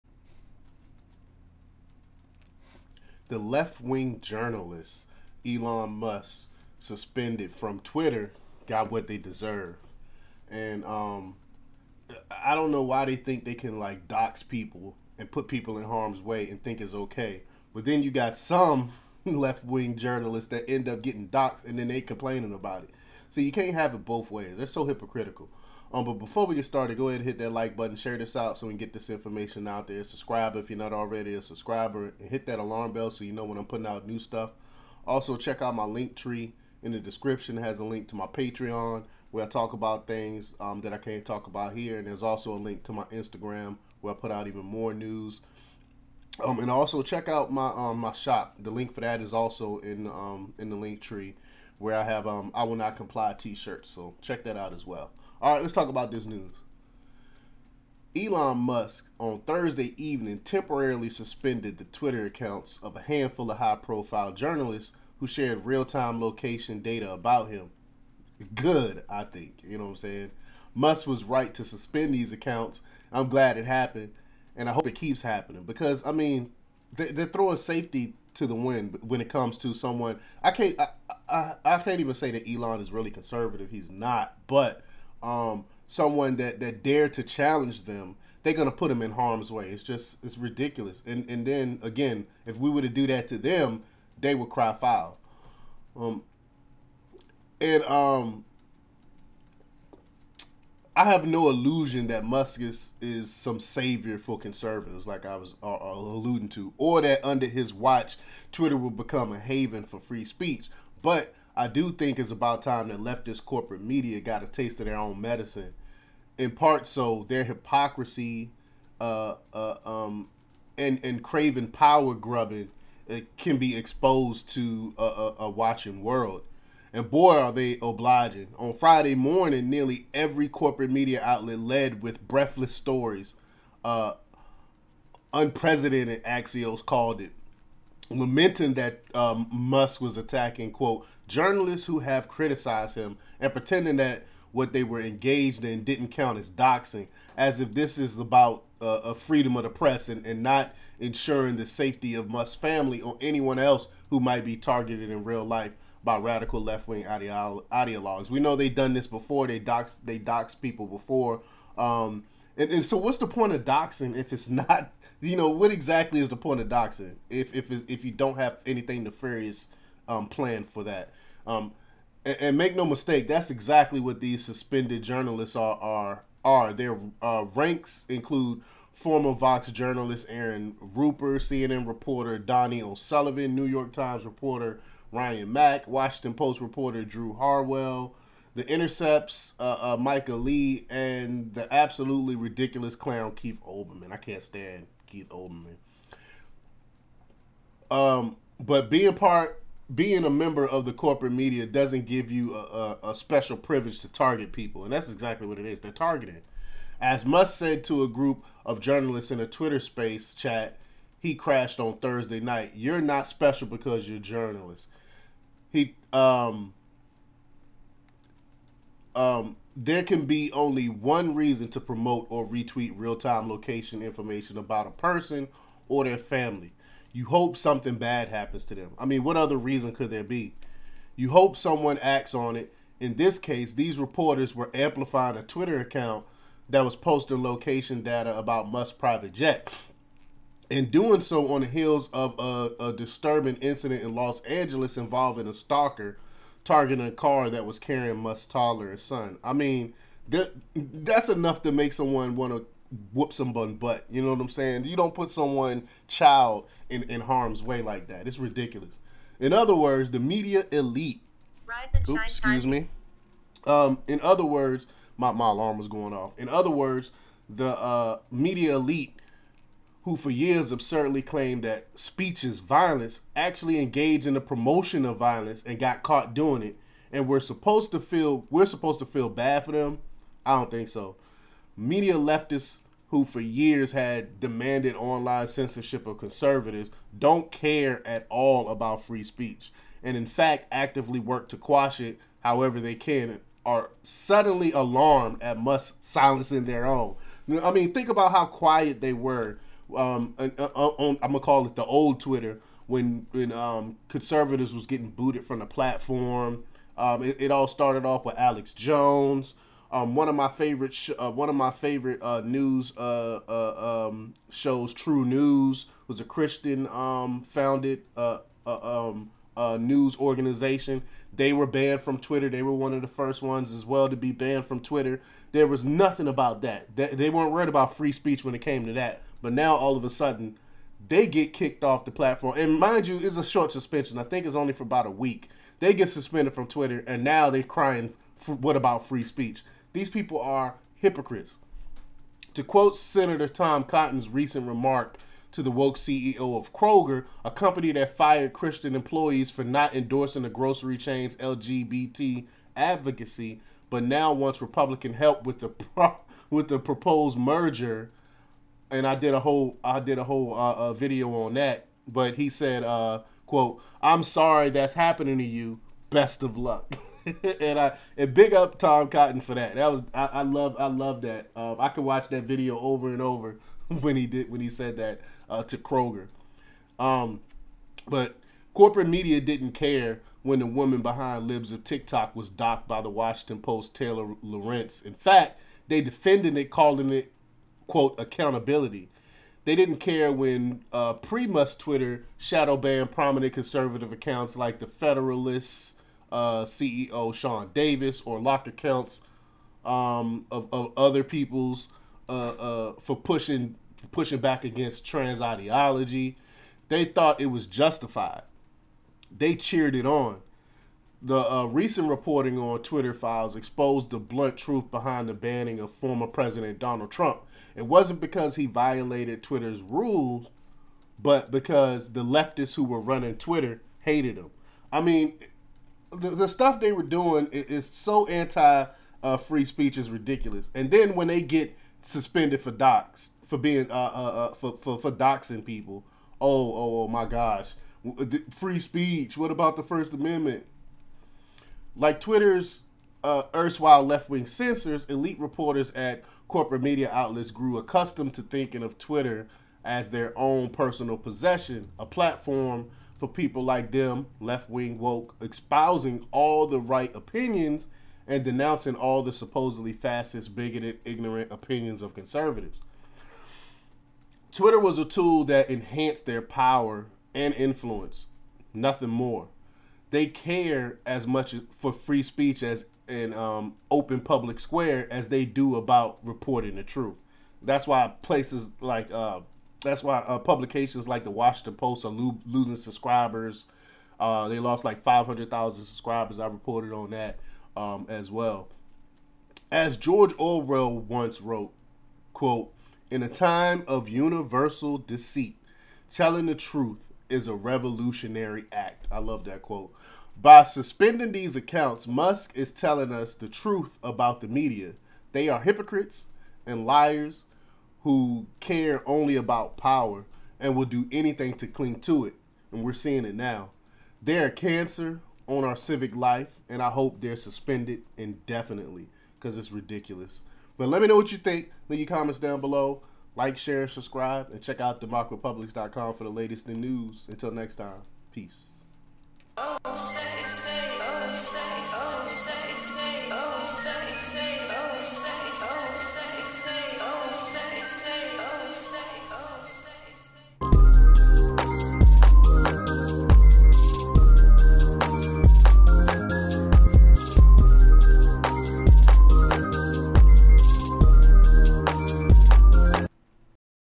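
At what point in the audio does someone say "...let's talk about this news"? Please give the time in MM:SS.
00:55.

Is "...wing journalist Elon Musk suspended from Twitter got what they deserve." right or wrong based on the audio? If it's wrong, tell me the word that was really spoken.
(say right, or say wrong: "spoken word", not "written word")
right.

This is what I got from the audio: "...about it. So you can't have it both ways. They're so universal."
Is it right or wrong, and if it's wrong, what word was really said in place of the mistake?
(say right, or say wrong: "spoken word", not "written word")
wrong: "hypocritical", not "universal".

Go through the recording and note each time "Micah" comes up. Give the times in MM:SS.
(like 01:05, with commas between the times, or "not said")
03:09.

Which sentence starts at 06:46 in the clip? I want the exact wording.
They thought it was justified they cheered it on.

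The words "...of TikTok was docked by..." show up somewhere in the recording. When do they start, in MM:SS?
06:21.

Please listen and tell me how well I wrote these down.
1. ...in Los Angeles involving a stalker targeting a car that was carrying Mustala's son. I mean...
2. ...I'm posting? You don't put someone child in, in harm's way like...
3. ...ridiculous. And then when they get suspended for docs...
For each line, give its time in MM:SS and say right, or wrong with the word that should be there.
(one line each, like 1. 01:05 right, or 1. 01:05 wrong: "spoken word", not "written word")
1. 04:04 right
2. 04:14 wrong: "saying", not "posting"
3. 07:10 right.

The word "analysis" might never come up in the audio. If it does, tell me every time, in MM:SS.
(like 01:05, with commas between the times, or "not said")
not said.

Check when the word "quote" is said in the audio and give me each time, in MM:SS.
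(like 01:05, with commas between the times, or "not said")
02:20, 05:42, 06:03, 06:27, 08:12, 08:19.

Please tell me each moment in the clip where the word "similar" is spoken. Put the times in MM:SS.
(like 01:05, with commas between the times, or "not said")
not said.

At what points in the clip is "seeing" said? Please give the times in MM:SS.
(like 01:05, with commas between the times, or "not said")
08:32.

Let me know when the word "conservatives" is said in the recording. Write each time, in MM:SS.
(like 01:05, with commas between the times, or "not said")
01:23, 01:44, 04:46, 05:04, 06:33, 07:42.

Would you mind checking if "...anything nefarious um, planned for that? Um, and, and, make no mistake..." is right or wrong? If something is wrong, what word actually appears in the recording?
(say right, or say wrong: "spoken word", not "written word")
right.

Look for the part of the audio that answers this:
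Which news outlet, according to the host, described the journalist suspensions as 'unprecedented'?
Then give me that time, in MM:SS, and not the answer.
02:16.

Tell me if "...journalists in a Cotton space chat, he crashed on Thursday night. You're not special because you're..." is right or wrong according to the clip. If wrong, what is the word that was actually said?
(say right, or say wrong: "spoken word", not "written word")
wrong: "Twitter", not "Cotton".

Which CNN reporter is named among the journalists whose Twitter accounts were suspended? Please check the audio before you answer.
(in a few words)
Donnie O'Sullivan.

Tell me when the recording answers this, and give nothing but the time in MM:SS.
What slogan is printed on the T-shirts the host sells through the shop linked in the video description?
00:52.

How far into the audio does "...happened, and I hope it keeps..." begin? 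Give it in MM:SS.
01:13.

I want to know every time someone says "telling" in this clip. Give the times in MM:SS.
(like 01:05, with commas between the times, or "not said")
08:16, 08:22.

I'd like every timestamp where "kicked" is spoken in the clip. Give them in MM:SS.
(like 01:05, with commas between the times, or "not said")
05:31.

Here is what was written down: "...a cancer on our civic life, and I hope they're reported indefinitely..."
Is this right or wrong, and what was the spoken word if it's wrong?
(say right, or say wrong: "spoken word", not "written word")
wrong: "suspended", not "reported".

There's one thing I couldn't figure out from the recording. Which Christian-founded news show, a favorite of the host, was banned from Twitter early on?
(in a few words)
True News.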